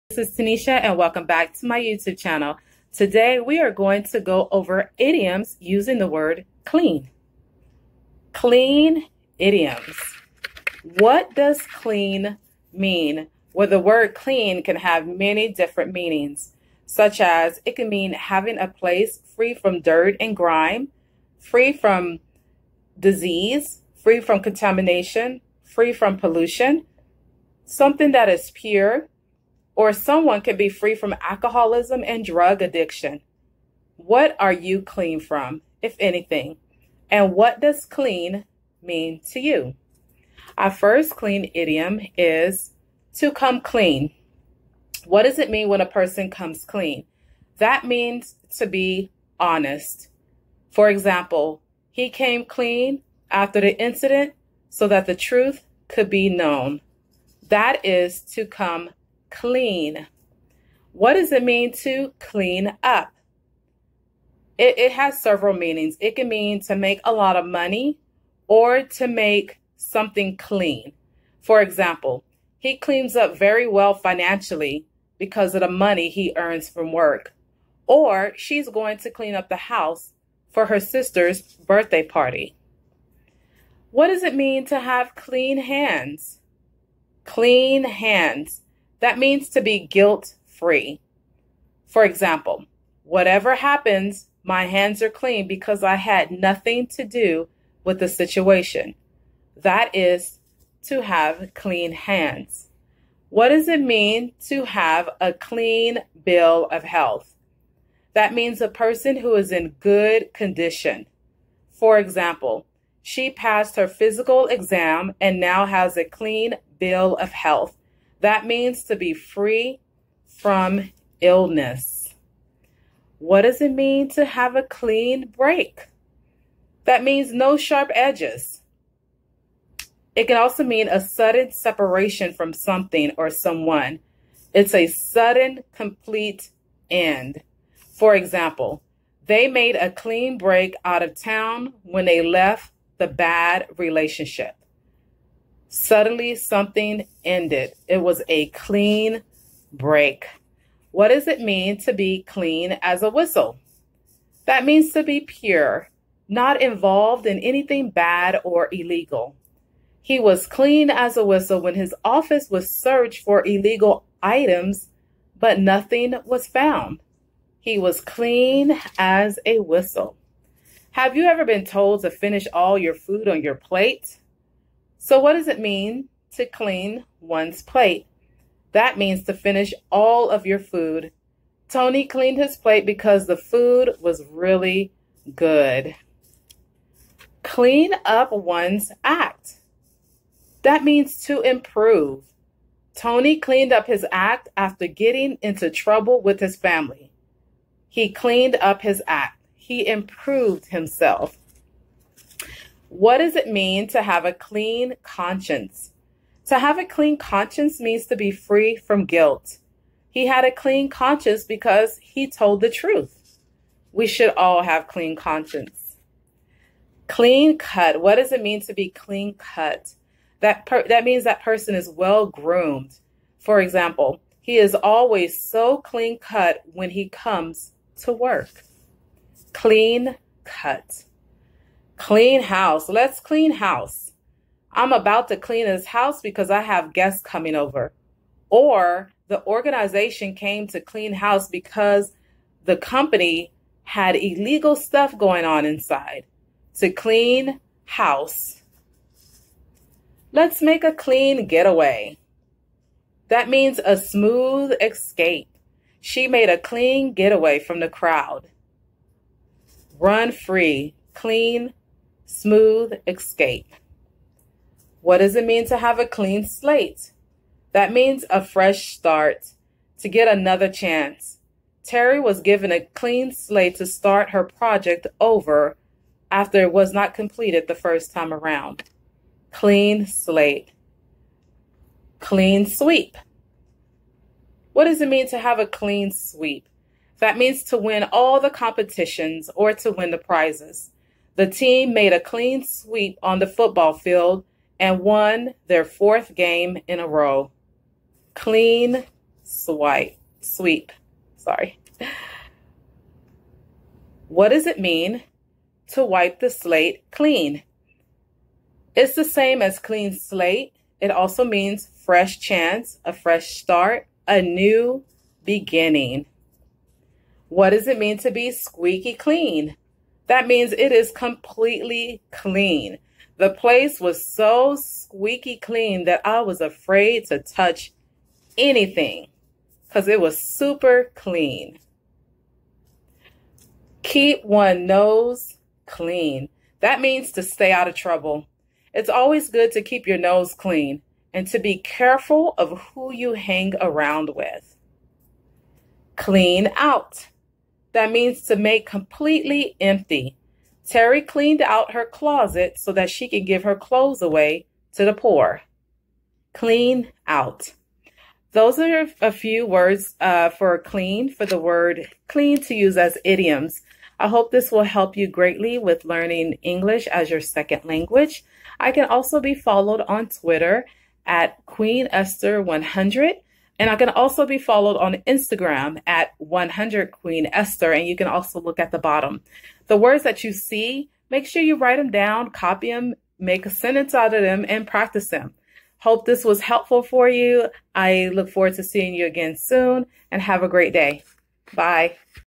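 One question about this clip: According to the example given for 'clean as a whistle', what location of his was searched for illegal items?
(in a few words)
his office.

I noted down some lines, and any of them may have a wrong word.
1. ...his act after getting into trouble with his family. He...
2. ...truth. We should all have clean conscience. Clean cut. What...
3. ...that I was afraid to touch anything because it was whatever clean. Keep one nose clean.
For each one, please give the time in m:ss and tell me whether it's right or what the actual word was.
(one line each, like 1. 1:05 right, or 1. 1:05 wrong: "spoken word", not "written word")
1. 3:13 right
2. 3:32 right
3. 5:26 wrong: "super", not "whatever".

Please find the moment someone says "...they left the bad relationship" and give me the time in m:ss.
2:22.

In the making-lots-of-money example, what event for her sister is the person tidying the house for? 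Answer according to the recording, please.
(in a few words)
birthday party.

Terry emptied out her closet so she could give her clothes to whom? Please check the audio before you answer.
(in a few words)
the poor.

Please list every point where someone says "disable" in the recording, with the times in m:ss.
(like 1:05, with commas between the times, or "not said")
not said.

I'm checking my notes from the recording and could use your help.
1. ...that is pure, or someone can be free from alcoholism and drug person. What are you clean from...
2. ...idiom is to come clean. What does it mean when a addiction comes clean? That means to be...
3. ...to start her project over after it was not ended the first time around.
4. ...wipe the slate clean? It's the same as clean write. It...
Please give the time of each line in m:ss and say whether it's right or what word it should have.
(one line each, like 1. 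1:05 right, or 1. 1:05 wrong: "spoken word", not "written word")
1. 0:28 wrong: "addiction", not "person"
2. 0:41 wrong: "person", not "addiction"
3. 4:33 wrong: "completed", not "ended"
4. 5:06 wrong: "slate", not "write".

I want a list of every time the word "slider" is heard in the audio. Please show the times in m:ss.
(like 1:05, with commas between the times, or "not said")
not said.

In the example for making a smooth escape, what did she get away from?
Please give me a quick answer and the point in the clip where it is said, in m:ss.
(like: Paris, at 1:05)
the crowd, at 4:17.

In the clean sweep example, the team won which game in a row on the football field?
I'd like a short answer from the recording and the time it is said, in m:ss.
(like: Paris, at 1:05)
fourth, at 4:55.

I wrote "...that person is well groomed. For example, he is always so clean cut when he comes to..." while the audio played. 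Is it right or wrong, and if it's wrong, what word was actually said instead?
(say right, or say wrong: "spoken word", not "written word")
right.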